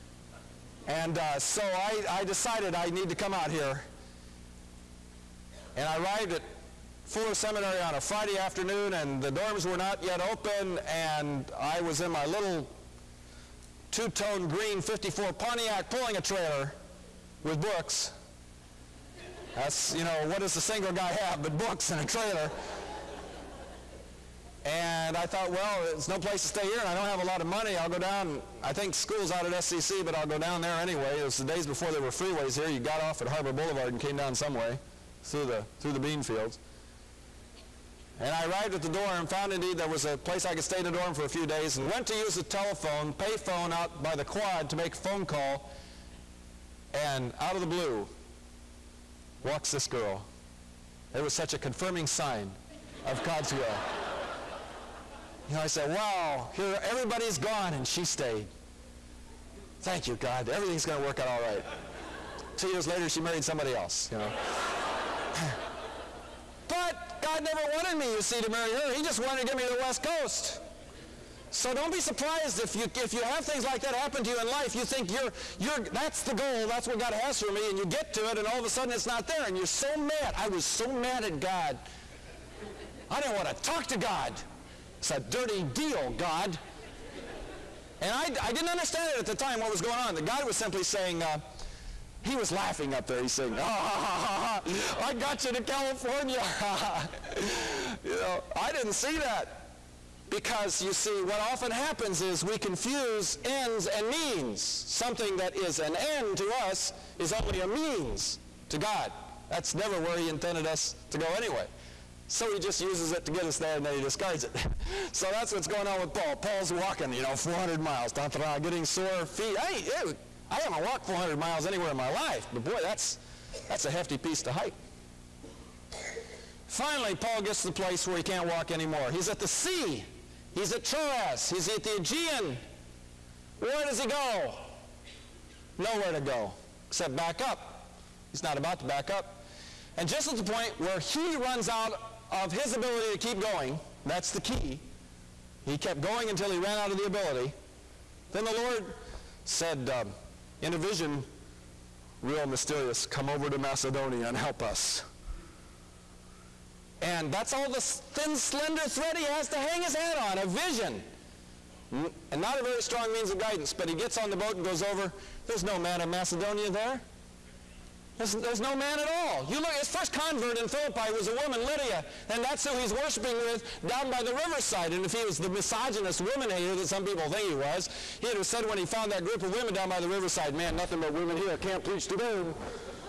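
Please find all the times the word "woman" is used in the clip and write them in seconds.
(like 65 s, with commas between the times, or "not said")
171 s, 176 s.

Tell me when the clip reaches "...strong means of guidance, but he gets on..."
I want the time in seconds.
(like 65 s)
162 s.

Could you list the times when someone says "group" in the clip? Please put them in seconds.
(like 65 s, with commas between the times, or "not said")
179 s.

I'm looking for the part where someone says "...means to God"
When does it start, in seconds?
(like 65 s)
107 s.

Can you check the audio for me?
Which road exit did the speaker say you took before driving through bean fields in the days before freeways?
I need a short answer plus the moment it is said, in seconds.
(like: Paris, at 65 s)
Harbor Boulevard, at 33 s.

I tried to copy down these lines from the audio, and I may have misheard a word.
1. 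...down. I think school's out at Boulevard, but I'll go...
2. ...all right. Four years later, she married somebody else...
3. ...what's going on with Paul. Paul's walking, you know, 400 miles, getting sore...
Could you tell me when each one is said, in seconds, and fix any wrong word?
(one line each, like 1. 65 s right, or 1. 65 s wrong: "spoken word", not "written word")
1. 27 s wrong: "SCC", not "Boulevard"
2. 61 s wrong: "Two", not "Four"
3. 115 s right.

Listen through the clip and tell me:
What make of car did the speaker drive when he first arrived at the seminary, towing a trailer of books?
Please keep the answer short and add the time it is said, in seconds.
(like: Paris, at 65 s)
1954 Pontiac, at 14 s.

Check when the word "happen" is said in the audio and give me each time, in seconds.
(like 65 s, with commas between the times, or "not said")
73 s, 101 s.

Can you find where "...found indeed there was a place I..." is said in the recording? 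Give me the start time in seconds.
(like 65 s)
39 s.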